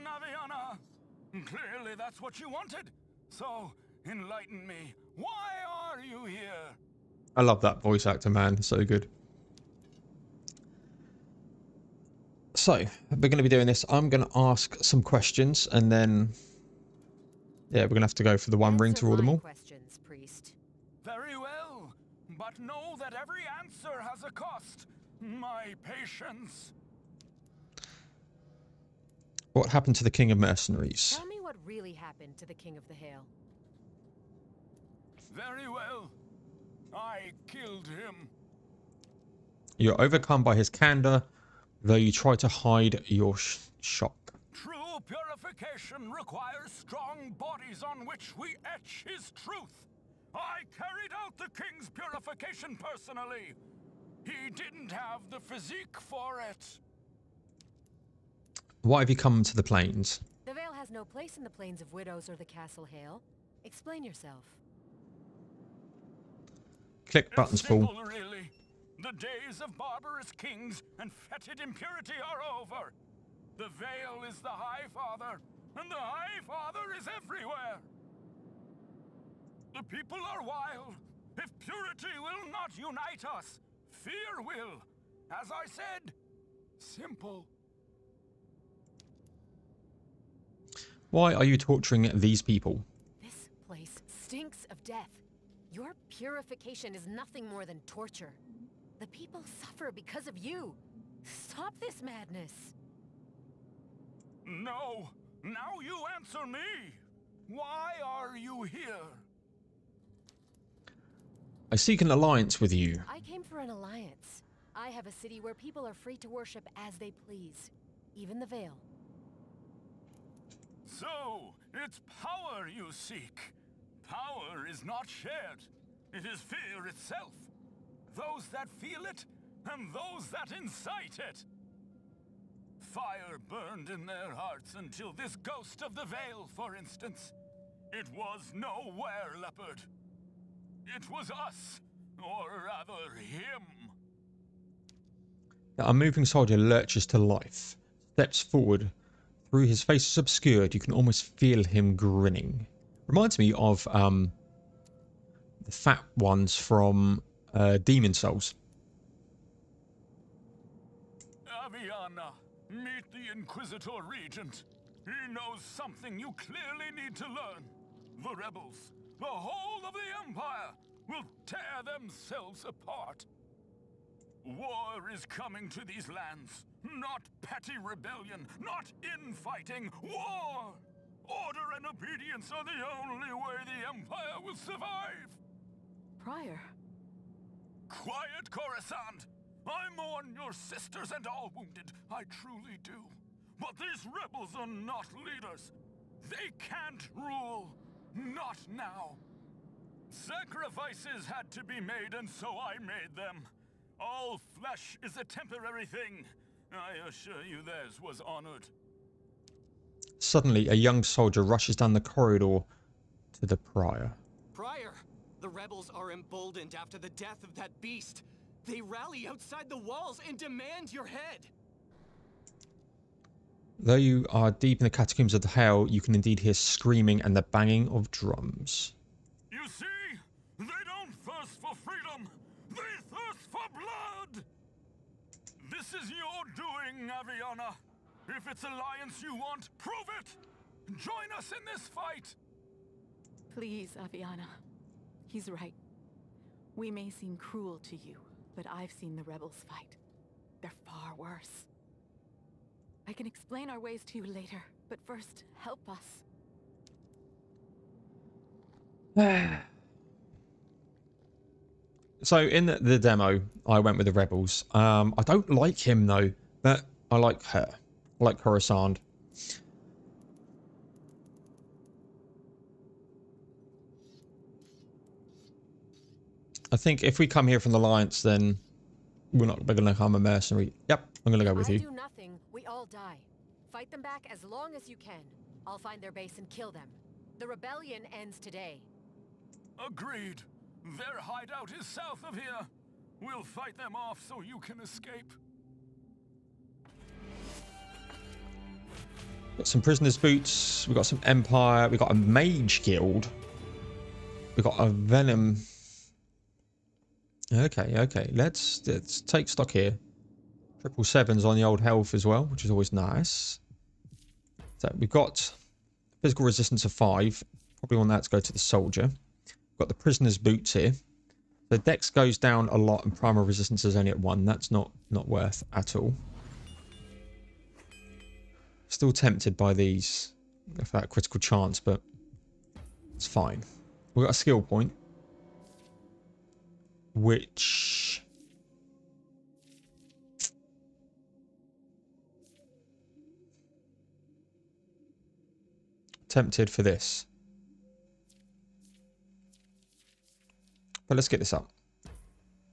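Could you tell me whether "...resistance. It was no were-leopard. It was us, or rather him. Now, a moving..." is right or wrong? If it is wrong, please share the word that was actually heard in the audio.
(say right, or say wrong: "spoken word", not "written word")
wrong: "instance", not "resistance".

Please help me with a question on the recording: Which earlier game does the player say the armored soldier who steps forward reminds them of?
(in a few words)
Demon's Souls.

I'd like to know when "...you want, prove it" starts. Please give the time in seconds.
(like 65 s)
239 s.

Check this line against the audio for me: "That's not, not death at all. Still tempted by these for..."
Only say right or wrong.
wrong.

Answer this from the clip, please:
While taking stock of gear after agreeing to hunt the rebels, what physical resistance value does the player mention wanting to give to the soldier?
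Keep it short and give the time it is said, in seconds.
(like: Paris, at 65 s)
5, at 316 s.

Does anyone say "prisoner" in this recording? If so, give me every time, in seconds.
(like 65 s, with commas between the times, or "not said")
299 s, 319 s.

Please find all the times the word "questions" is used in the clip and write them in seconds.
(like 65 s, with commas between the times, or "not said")
15 s, 19 s.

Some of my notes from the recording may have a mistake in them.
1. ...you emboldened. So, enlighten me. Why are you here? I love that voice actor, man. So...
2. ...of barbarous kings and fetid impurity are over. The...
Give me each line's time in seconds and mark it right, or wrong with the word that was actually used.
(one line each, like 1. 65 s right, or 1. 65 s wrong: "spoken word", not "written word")
1. 2 s wrong: "wanted", not "emboldened"
2. 69 s right.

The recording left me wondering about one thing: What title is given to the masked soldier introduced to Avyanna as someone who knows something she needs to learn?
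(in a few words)
Inquisitor Regent.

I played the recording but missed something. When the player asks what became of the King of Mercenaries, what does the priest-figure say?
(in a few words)
I killed him.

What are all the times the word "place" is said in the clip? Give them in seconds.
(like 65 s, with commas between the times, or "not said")
61 s, 93 s.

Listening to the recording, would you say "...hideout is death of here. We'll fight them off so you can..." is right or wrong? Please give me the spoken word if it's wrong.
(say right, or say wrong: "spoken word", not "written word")
wrong: "south", not "death".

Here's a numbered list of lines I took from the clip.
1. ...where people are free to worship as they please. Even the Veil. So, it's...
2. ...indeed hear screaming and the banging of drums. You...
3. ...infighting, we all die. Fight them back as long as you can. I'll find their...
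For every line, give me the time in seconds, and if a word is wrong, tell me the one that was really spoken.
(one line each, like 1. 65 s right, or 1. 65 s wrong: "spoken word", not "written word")
1. 115 s right
2. 226 s right
3. 281 s wrong: "nothing", not "infighting".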